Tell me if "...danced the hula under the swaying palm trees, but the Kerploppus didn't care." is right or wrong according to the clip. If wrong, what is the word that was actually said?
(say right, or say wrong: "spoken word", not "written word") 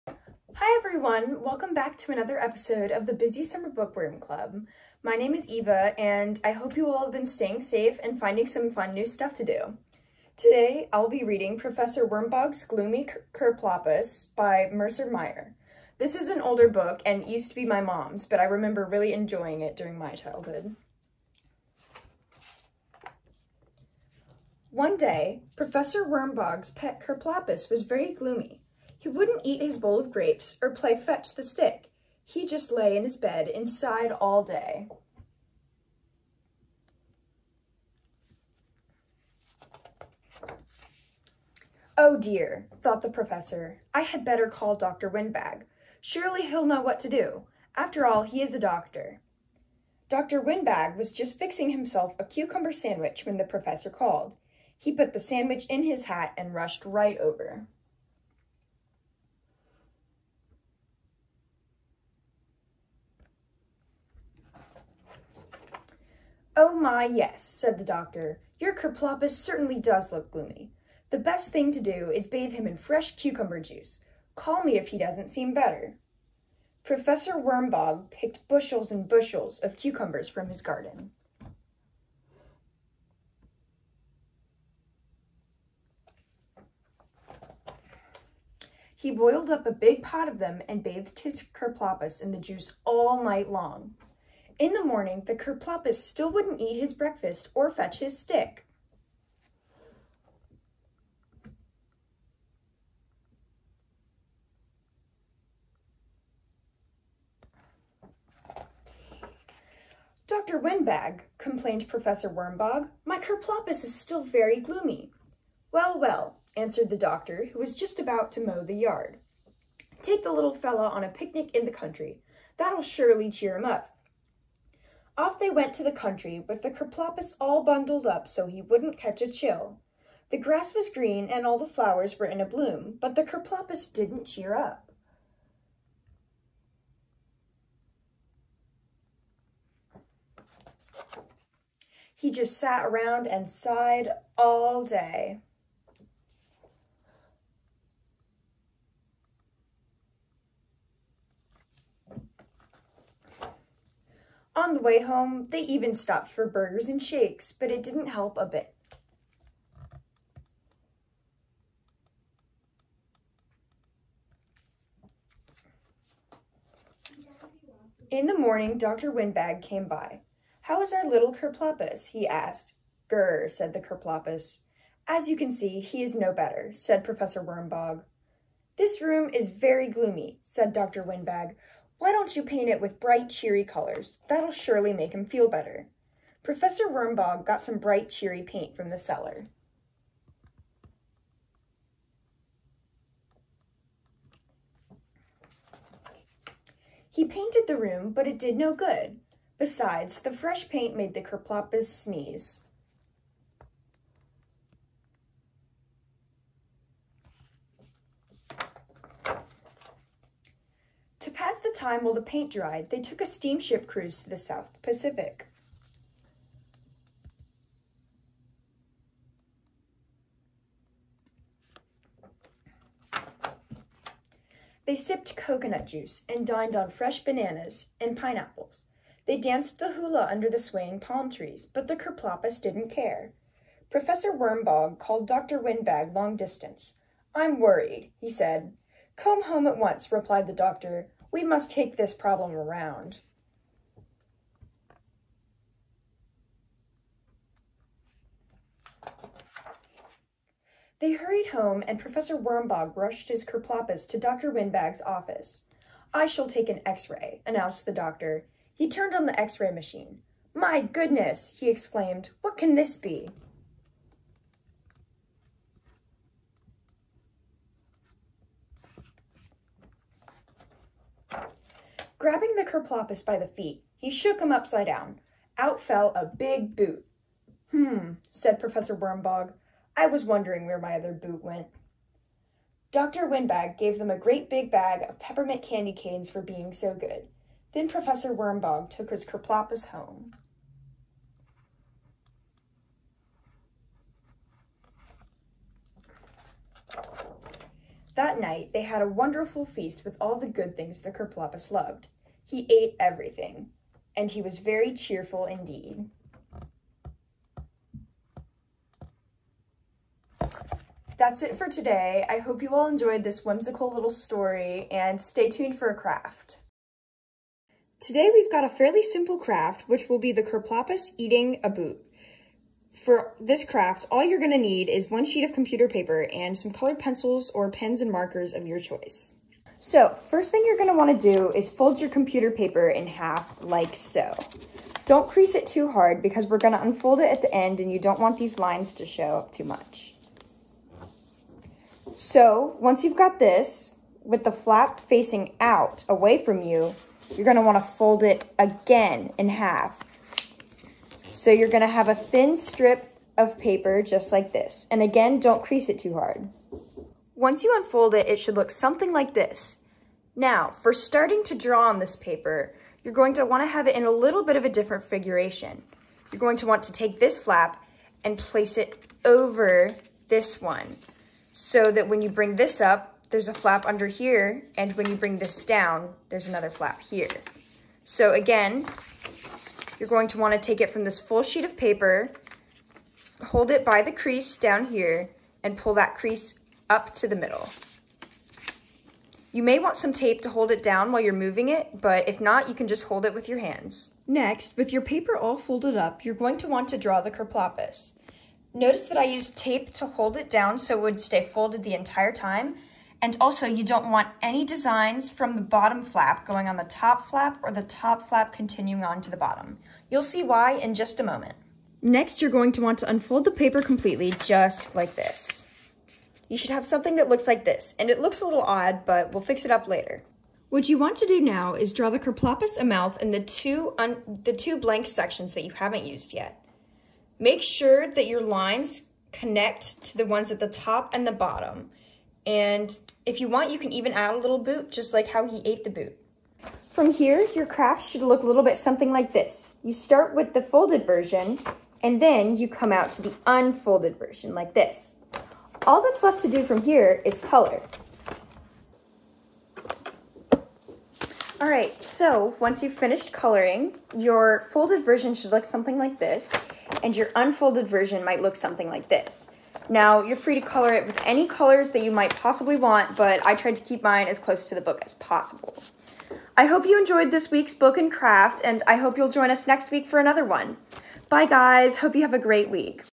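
right.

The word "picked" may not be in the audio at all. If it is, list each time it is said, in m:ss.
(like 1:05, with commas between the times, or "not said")
1:18.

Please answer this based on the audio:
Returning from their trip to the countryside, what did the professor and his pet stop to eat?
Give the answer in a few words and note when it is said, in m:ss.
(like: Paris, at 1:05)
burgers and shakes, at 2:36.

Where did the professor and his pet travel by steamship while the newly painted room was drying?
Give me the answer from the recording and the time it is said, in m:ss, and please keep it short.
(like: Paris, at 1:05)
South Pacific, at 3:34.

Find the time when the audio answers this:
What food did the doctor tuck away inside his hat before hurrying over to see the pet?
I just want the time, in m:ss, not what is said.
0:52.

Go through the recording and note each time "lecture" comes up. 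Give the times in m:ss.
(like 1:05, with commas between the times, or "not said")
not said.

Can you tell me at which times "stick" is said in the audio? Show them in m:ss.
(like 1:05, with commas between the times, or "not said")
0:31, 1:38.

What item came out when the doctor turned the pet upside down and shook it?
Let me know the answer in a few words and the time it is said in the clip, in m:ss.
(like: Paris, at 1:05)
a big boot, at 4:36.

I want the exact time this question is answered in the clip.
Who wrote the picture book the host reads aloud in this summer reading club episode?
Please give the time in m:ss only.
0:14.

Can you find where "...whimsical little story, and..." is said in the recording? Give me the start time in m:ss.
5:13.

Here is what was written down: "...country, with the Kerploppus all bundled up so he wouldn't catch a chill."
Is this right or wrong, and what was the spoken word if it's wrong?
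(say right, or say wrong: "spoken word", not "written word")
right.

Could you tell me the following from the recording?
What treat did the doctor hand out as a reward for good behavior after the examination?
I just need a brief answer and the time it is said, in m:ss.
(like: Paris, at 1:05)
peppermint candy canes, at 4:45.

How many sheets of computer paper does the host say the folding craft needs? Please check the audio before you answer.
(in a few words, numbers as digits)
1.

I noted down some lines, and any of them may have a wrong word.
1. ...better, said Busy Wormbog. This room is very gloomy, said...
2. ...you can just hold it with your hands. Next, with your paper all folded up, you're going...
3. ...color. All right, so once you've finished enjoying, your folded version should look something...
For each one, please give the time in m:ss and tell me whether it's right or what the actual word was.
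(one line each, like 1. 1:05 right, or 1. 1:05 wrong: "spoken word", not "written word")
1. 2:56 wrong: "Professor", not "Busy"
2. 6:32 right
3. 7:27 wrong: "coloring", not "enjoying".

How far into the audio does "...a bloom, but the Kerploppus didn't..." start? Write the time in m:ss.
2:12.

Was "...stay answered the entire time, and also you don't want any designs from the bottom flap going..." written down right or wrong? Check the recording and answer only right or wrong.
wrong.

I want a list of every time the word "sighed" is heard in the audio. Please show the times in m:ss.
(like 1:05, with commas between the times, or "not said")
0:33, 2:23.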